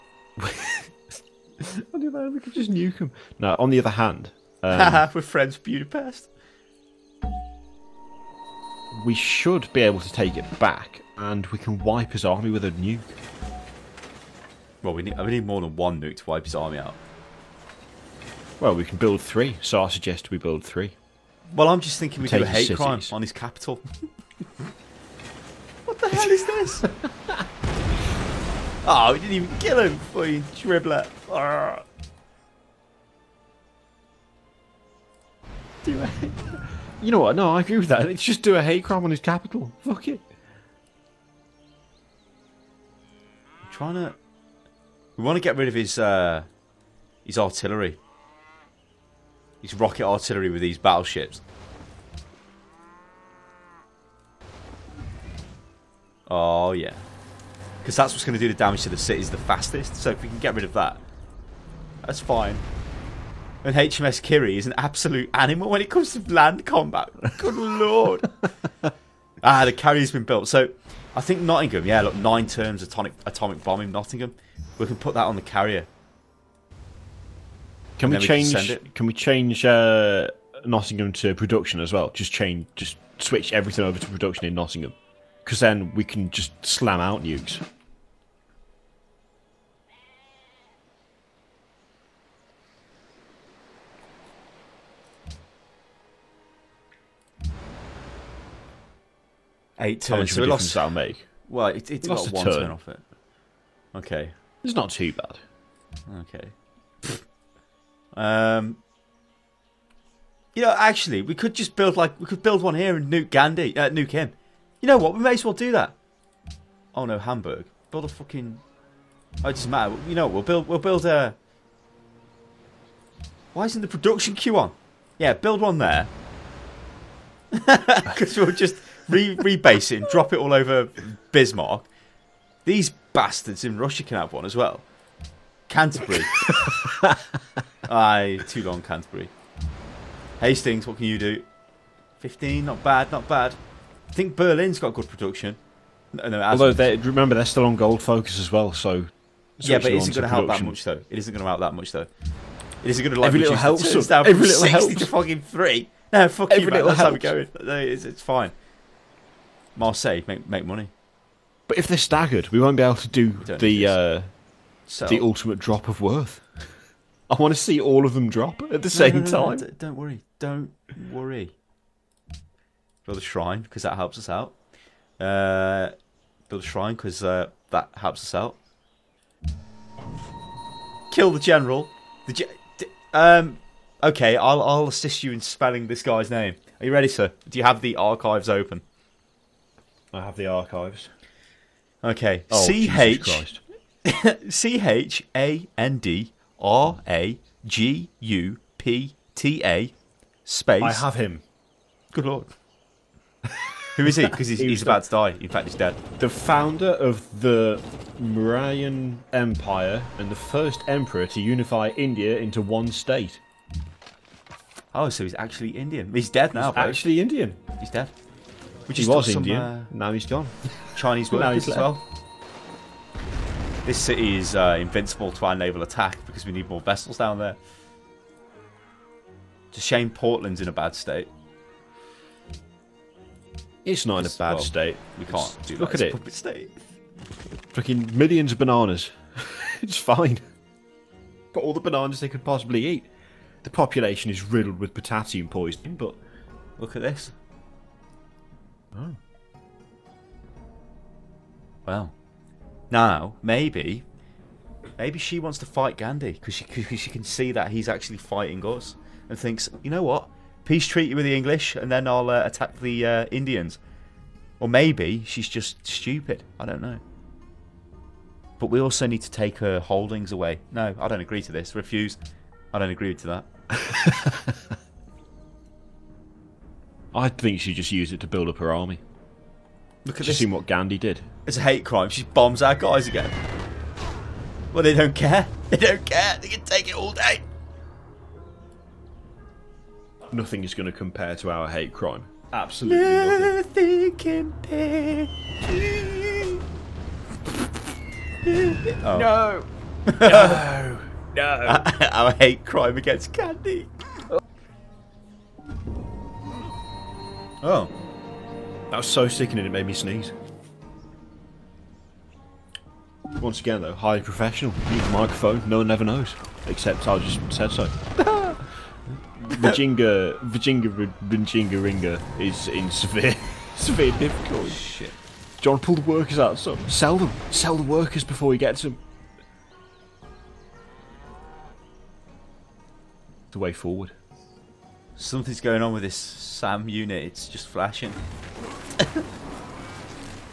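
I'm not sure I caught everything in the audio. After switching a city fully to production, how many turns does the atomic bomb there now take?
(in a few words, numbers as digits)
8.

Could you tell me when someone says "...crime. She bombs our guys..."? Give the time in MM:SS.
04:41.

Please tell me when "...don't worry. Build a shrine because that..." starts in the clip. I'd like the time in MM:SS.
02:50.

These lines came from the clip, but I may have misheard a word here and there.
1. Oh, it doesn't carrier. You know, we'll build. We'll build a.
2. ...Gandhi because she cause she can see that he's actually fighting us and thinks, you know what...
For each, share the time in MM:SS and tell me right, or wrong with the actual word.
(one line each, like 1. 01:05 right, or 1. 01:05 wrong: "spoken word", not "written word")
1. 01:59 wrong: "matter", not "carrier"
2. 04:15 right.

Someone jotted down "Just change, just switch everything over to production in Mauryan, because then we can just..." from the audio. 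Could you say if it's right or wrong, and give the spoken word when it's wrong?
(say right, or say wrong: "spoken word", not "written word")
wrong: "Nottingham", not "Mauryan".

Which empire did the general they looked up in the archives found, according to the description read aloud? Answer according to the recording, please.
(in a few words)
Mauryan Empire.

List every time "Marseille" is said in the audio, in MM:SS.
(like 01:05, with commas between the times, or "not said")
02:39.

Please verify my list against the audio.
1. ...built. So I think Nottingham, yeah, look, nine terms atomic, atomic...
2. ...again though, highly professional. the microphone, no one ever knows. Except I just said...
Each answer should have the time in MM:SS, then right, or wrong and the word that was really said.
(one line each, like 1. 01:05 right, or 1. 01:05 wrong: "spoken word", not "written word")
1. 01:10 right
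2. 05:13 right.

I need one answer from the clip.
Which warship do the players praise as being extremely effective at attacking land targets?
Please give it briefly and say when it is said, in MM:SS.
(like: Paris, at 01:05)
HMS Kiri, at 01:03.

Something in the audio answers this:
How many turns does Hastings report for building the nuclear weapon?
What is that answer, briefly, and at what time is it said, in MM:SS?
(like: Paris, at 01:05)
15, at 02:22.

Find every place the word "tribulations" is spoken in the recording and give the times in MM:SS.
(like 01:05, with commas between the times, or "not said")
not said.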